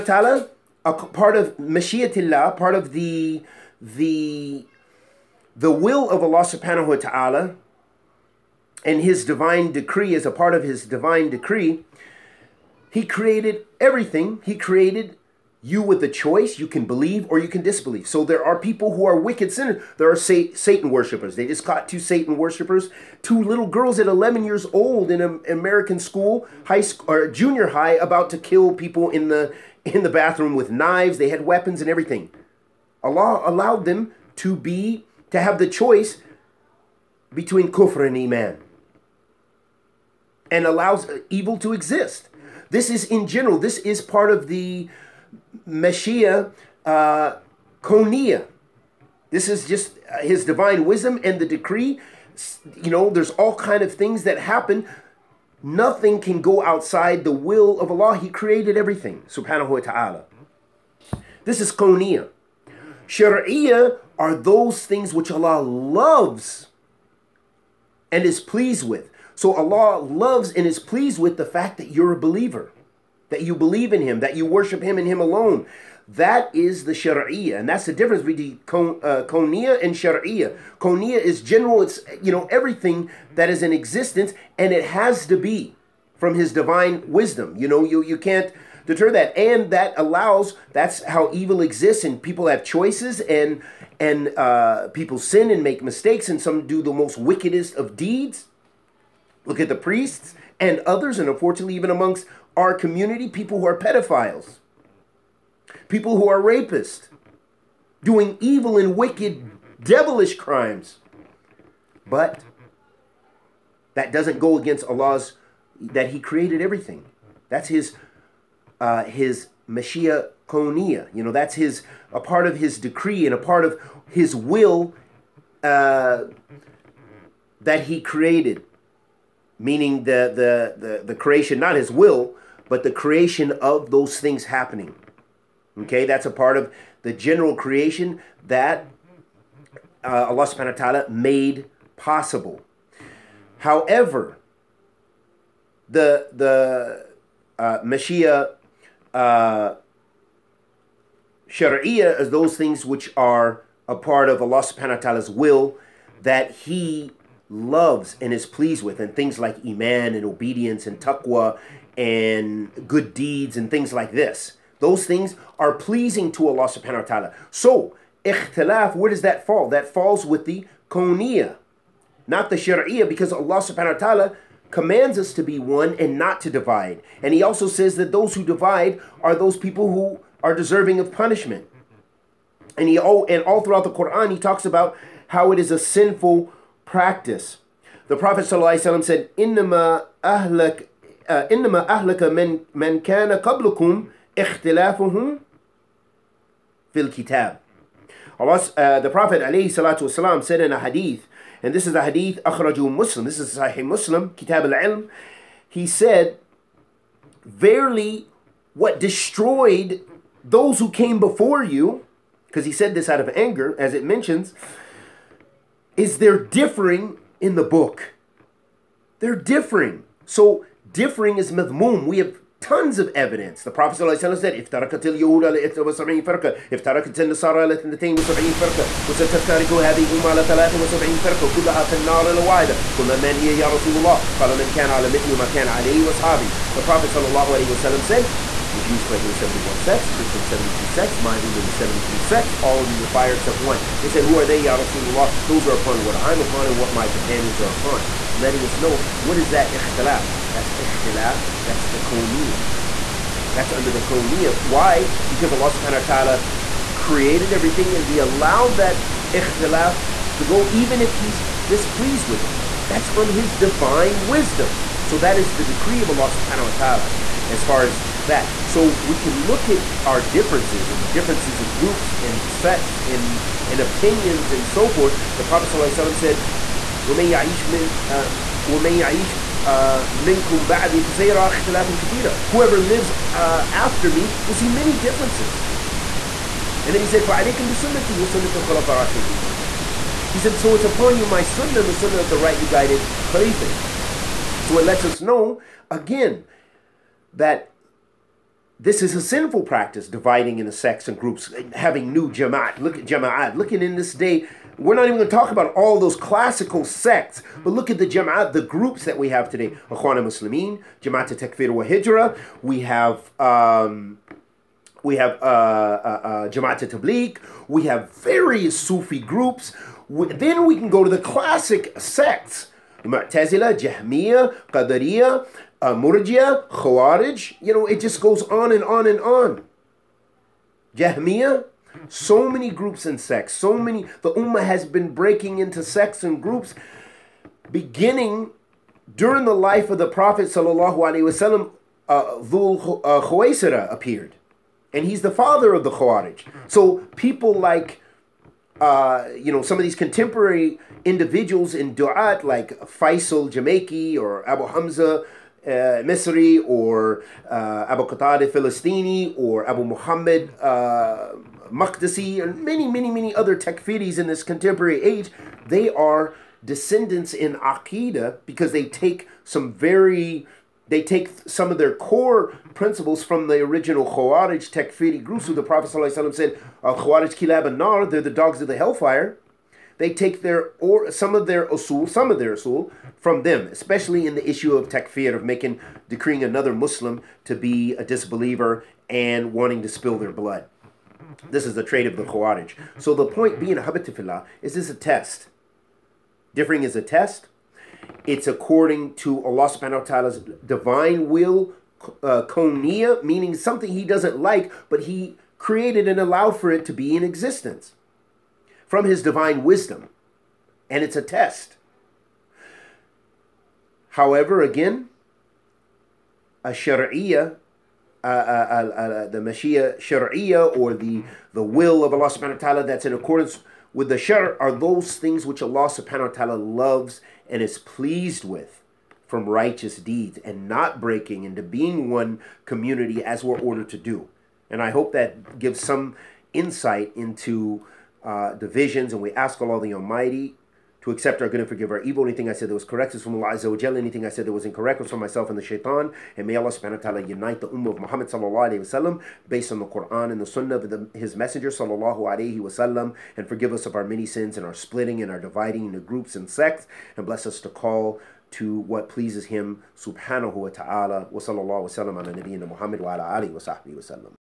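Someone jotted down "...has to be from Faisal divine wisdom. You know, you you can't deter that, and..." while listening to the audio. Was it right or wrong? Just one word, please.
wrong.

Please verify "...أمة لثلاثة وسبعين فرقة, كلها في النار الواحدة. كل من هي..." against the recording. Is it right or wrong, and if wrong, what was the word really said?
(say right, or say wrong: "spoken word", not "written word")
right.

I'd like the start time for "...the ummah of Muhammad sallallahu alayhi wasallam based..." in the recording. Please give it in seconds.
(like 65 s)
447 s.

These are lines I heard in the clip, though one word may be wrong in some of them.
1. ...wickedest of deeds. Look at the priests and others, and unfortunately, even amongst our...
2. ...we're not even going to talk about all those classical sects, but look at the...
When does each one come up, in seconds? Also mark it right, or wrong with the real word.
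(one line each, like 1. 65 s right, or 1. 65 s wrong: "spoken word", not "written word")
1. 97 s right
2. 304 s right.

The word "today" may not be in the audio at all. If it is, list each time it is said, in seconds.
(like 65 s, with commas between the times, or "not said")
309 s.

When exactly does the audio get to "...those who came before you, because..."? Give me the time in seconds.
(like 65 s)
210 s.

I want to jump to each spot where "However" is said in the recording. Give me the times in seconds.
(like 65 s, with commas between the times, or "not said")
143 s, 414 s.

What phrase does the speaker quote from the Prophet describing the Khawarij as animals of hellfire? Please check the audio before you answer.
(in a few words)
Kilab Nar.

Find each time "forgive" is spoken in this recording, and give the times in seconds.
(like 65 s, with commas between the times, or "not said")
441 s, 453 s.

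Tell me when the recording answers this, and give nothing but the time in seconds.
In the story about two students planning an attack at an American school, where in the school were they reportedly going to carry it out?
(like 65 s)
30 s.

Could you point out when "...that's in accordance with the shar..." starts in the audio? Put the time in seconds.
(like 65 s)
422 s.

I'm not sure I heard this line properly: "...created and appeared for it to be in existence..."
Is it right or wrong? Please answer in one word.
wrong.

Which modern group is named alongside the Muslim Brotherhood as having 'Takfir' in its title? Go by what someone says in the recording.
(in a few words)
Jama'at Takfir wa Hijra.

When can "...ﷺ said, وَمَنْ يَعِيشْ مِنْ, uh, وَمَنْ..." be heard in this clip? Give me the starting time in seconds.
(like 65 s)
275 s.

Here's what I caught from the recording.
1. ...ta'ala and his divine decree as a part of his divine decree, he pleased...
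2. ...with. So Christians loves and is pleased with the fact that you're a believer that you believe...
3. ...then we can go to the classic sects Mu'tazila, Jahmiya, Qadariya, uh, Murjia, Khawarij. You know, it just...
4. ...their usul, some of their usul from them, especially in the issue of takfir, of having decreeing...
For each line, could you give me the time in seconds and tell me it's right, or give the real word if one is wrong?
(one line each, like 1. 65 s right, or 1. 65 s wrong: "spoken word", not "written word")
1. 6 s wrong: "created", not "pleased"
2. 68 s wrong: "Allah", not "Christians"
3. 320 s right
4. 381 s wrong: "making", not "having".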